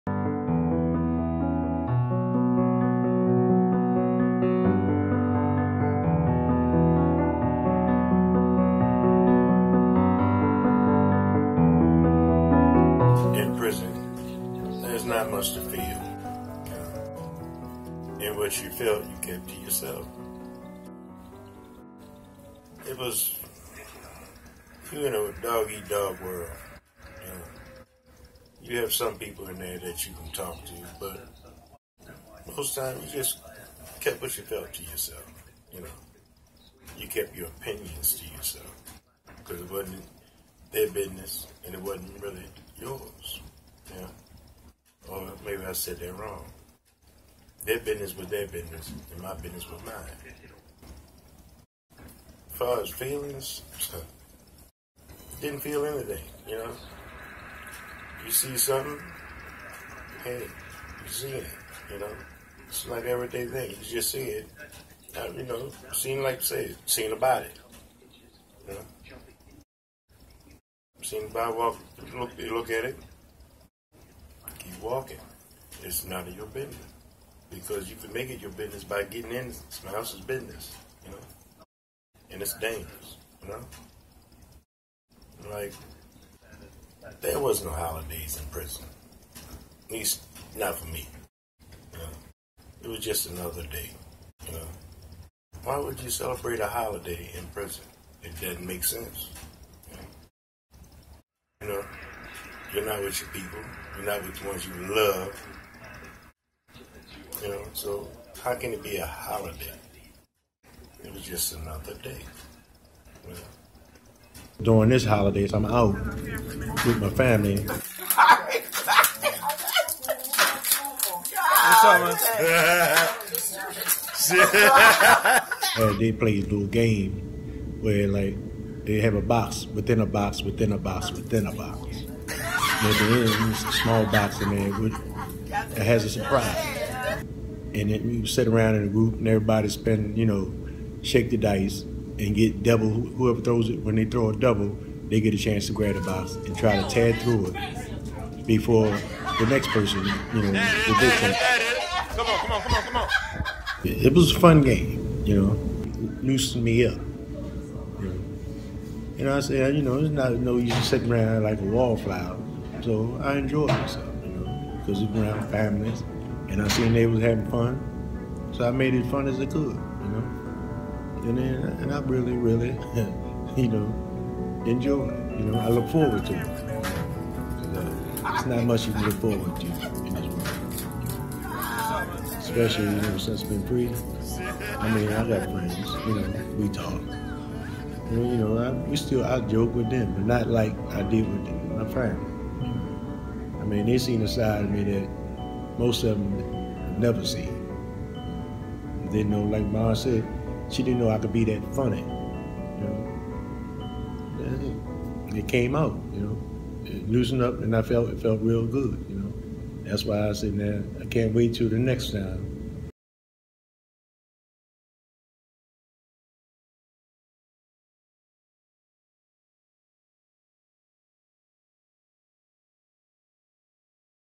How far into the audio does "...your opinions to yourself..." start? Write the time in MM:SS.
00:37.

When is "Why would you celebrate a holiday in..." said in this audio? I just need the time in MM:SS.
01:35.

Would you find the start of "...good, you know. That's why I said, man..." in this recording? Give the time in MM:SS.
03:28.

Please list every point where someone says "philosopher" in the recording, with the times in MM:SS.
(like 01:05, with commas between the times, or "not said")
not said.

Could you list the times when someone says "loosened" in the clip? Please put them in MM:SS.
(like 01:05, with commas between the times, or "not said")
02:36, 03:27.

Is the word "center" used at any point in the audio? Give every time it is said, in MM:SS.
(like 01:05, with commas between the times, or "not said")
not said.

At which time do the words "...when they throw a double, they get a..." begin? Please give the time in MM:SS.
02:23.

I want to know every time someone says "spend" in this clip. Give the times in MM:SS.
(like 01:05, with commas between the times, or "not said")
02:19.